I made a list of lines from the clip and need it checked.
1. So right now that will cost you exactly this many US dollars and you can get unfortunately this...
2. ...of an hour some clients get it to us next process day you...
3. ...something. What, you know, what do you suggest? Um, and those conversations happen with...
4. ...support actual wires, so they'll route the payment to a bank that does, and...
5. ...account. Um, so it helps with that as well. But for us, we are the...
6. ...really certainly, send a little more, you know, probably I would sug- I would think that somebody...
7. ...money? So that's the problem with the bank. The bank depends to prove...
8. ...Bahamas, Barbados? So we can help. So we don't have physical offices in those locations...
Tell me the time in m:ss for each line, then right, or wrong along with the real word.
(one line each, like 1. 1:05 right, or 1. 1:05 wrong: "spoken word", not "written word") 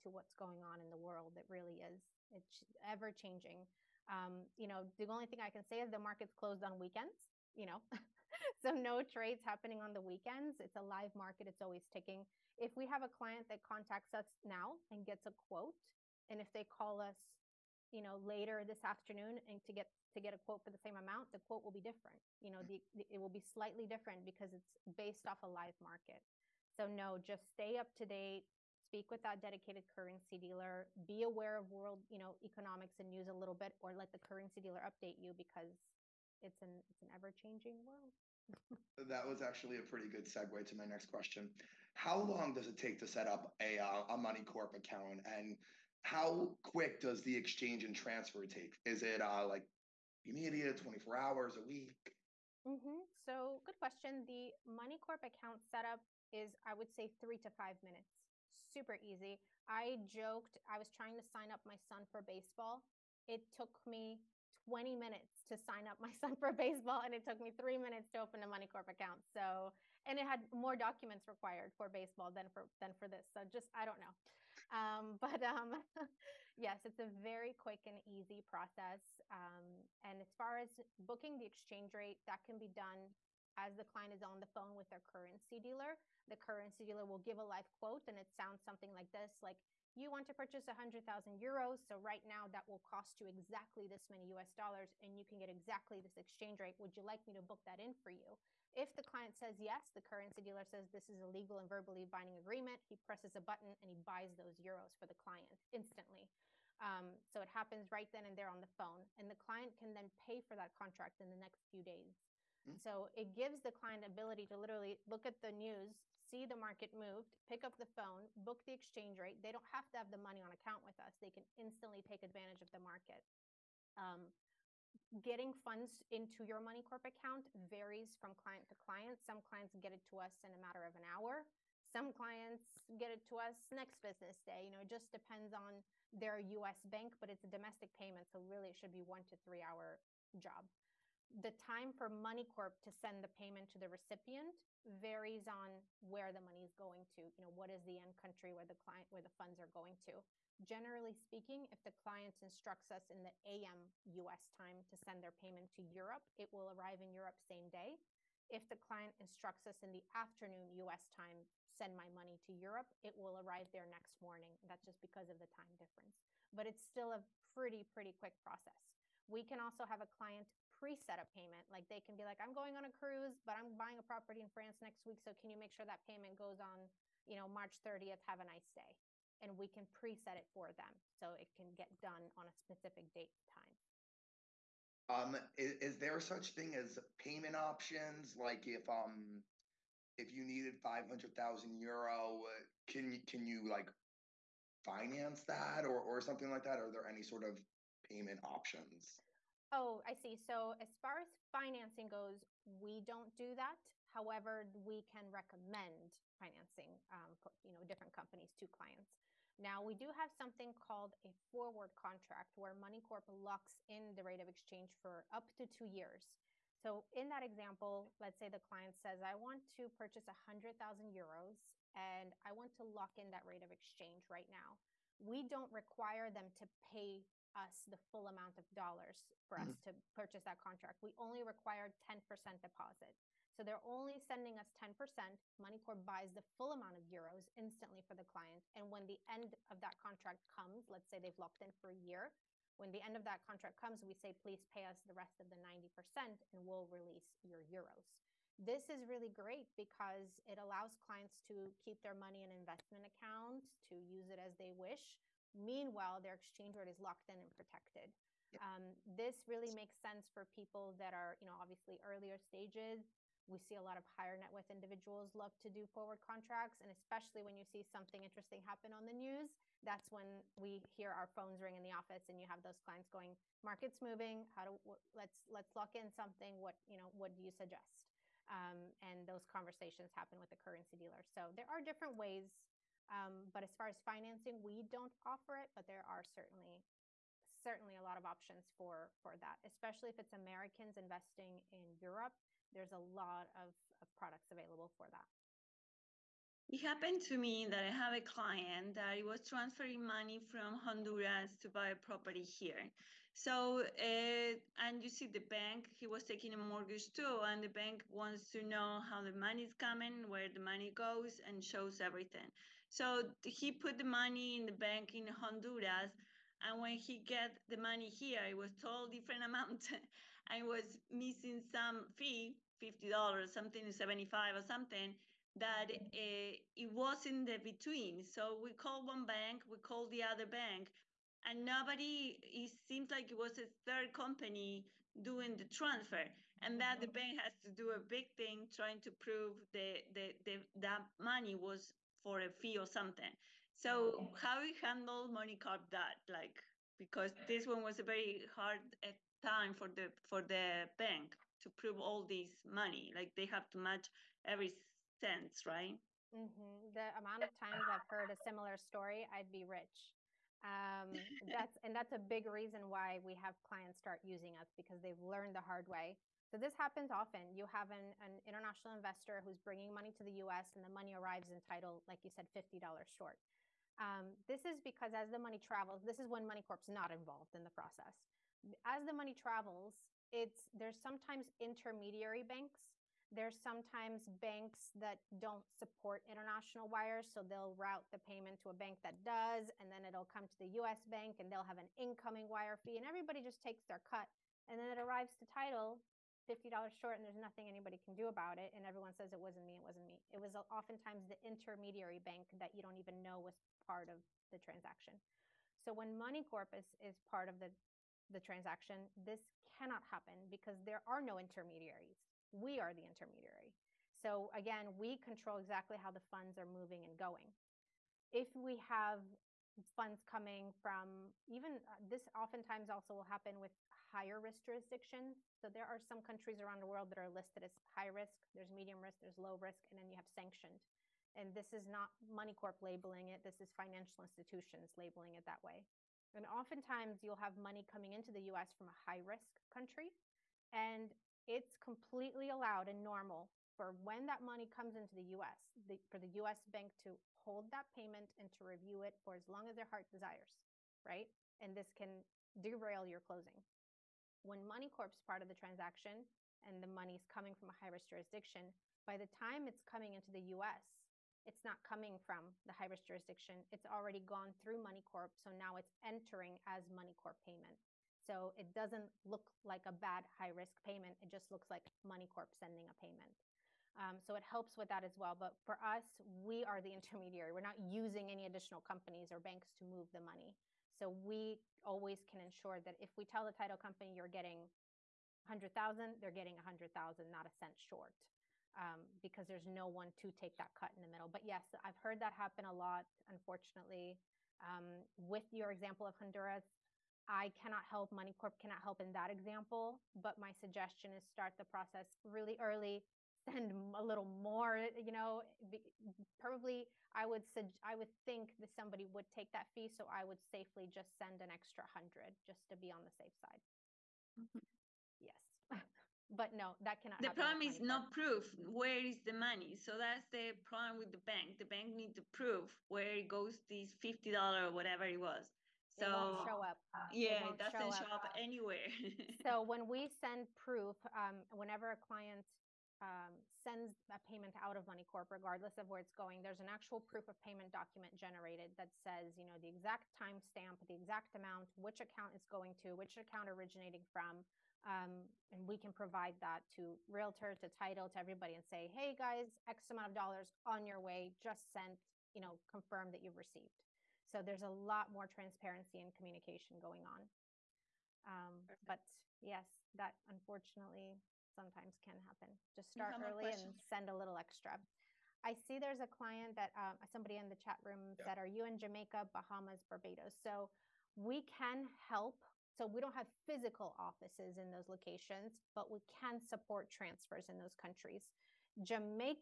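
1. 1:31 wrong: "exactly", not "unfortunately"
2. 2:10 wrong: "business", not "process"
3. 4:36 right
4. 6:25 wrong: "international", not "actual"
5. 7:52 wrong: "payment", not "account"
6. 8:22 wrong: "early", not "certainly"
7. 8:39 wrong: "needs", not "depends"
8. 9:29 right.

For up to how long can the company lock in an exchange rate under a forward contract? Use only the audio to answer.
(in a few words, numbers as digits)
2 years.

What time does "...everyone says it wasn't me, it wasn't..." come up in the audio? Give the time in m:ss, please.
6:38.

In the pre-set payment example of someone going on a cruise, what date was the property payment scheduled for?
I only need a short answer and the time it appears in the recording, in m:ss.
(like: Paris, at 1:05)
March 30th, at 2:57.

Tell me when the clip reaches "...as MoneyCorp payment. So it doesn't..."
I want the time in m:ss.
7:46.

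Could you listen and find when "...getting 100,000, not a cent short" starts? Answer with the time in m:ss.
8:06.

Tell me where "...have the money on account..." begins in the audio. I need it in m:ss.
1:59.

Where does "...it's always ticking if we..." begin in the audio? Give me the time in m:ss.
0:11.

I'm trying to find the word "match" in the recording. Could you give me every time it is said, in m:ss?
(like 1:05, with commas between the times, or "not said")
5:53.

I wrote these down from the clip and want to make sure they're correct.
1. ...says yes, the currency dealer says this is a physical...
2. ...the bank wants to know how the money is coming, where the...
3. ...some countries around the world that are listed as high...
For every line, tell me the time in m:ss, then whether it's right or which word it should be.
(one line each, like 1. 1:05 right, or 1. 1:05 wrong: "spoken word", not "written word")
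1. 1:39 wrong: "legal", not "physical"
2. 5:07 right
3. 7:05 right.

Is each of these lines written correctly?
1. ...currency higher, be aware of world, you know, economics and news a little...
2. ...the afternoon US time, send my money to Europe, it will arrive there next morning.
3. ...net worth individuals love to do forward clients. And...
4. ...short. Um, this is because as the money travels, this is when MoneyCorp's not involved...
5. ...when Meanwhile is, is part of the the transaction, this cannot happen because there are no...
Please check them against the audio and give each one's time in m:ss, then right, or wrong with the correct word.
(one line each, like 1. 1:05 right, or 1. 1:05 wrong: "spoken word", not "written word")
1. 0:29 wrong: "dealer", not "higher"
2. 2:39 right
3. 4:24 wrong: "contracts", not "clients"
4. 6:13 right
5. 6:45 wrong: "MoneyCorp", not "Meanwhile".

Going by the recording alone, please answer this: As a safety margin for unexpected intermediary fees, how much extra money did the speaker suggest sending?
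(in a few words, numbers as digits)
100.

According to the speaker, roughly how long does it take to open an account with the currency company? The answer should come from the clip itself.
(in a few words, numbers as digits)
3 to 5 minutes.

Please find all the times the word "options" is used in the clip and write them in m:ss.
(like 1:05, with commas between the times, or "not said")
3:07, 3:18, 4:48.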